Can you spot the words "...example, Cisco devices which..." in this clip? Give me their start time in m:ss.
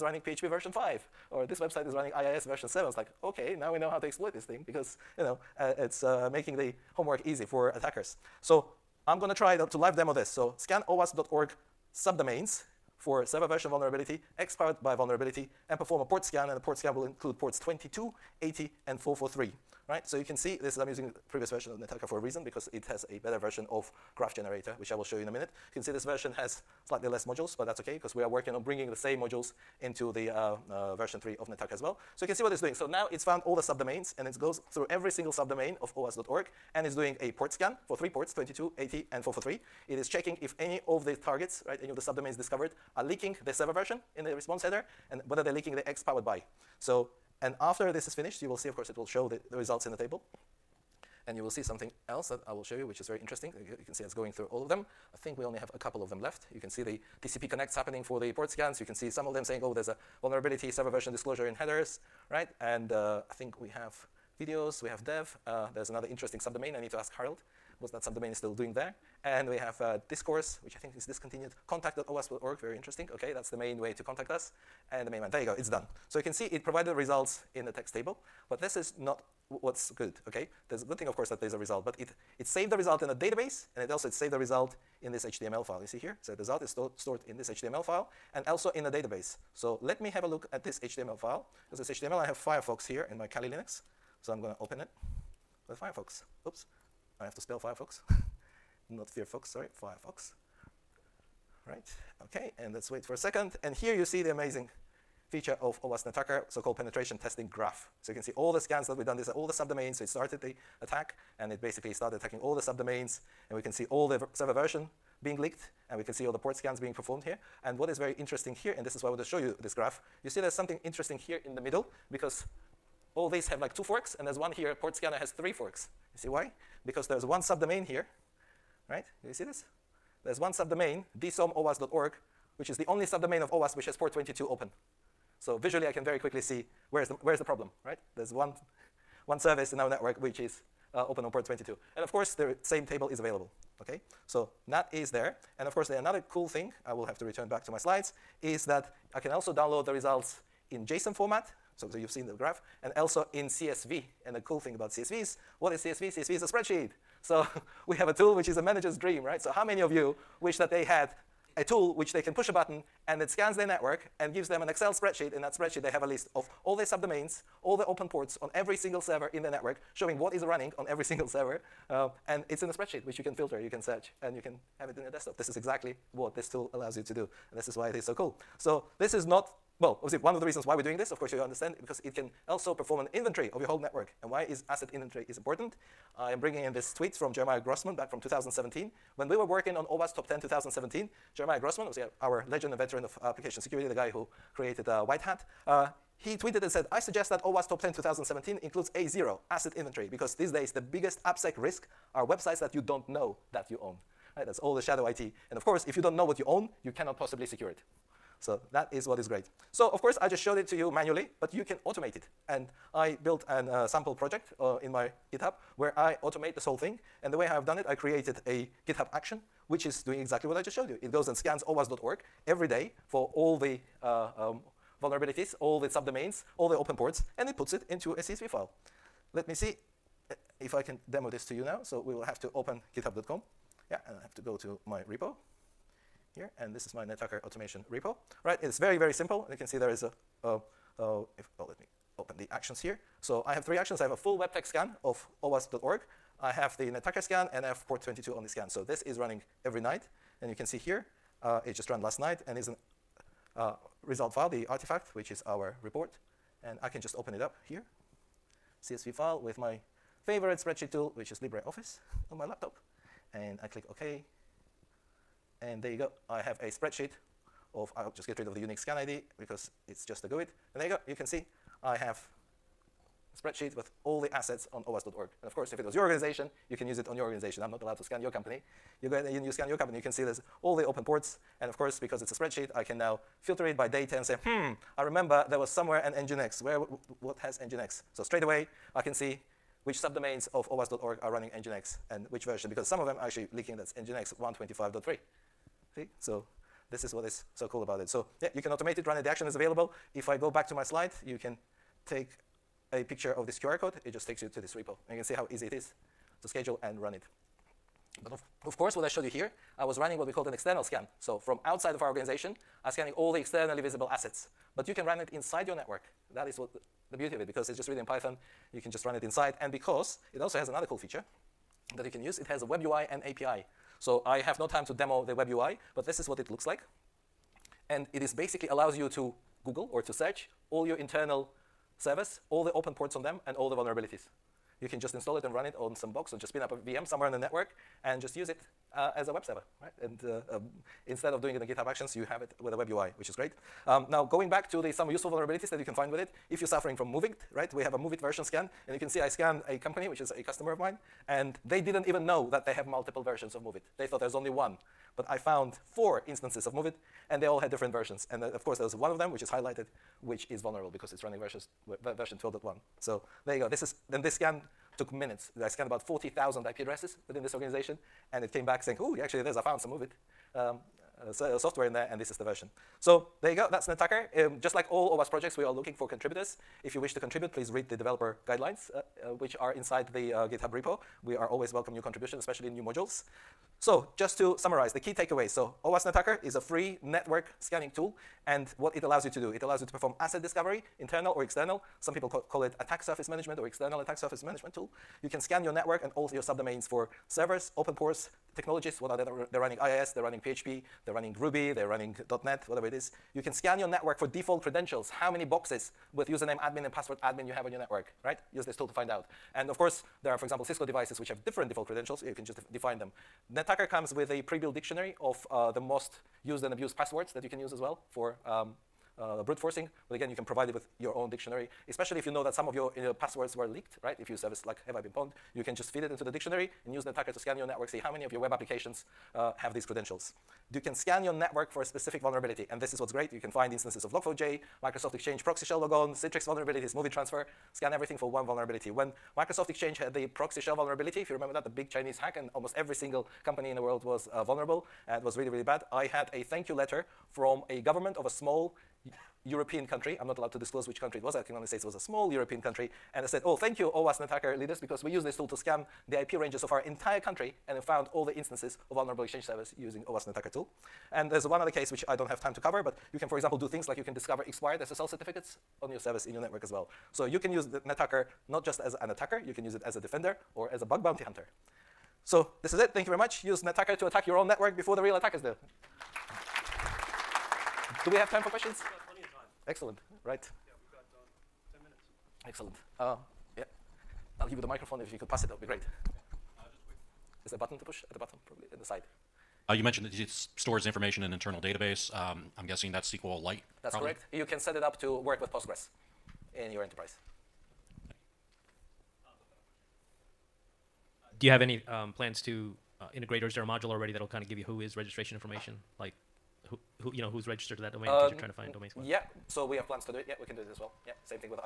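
6:50.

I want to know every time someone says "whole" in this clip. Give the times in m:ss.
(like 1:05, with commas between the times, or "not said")
3:03, 3:36.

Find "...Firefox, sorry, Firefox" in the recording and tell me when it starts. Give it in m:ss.
1:39.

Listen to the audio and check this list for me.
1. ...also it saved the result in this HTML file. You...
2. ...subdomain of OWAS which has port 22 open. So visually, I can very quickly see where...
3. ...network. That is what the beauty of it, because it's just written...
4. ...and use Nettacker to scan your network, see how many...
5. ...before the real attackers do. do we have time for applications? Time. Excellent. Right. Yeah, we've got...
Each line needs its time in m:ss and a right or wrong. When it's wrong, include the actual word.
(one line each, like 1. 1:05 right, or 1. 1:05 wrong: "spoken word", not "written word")
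1. 1:23 right
2. 2:13 right
3. 5:15 right
4. 7:06 right
5. 7:54 wrong: "questions", not "applications".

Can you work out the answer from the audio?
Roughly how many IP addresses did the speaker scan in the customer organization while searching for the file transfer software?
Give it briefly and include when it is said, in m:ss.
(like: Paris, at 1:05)
40,000, at 6:06.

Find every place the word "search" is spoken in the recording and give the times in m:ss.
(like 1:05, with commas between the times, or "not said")
2:53, 5:30.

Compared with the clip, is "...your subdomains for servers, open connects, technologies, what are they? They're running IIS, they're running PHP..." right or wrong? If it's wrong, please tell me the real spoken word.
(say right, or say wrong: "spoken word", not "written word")
wrong: "ports", not "connects".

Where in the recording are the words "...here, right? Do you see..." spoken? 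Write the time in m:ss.
2:07.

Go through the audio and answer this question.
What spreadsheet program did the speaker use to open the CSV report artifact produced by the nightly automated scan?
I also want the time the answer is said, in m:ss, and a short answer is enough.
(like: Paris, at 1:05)
LibreOffice, at 4:21.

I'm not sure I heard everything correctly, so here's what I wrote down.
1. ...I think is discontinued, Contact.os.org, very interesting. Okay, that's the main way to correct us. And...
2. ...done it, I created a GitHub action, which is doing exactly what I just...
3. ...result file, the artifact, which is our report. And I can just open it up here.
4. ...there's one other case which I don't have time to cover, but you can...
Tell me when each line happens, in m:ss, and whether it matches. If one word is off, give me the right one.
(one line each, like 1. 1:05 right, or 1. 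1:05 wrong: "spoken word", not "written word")
1. 1:10 wrong: "contact", not "correct"
2. 3:37 right
3. 4:14 right
4. 7:41 right.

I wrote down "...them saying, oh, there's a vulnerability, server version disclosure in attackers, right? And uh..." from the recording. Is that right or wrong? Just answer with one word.
wrong.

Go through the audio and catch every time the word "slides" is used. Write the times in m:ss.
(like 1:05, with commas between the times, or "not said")
2:27, 5:00.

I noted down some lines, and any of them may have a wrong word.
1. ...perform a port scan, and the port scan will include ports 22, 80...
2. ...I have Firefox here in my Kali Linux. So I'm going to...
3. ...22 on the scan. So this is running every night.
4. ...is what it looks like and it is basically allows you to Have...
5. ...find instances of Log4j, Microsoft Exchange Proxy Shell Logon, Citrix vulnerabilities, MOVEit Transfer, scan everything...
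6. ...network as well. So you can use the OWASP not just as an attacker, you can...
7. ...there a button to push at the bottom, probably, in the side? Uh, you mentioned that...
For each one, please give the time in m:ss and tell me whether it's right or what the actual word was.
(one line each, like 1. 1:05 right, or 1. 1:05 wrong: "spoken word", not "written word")
1. 0:15 right
2. 1:32 right
3. 4:08 right
4. 5:26 wrong: "Google", not "Have"
5. 7:13 right
6. 7:46 wrong: "Nettacker", not "OWASP"
7. 8:07 right.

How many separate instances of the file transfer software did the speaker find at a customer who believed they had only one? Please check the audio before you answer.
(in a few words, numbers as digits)
4.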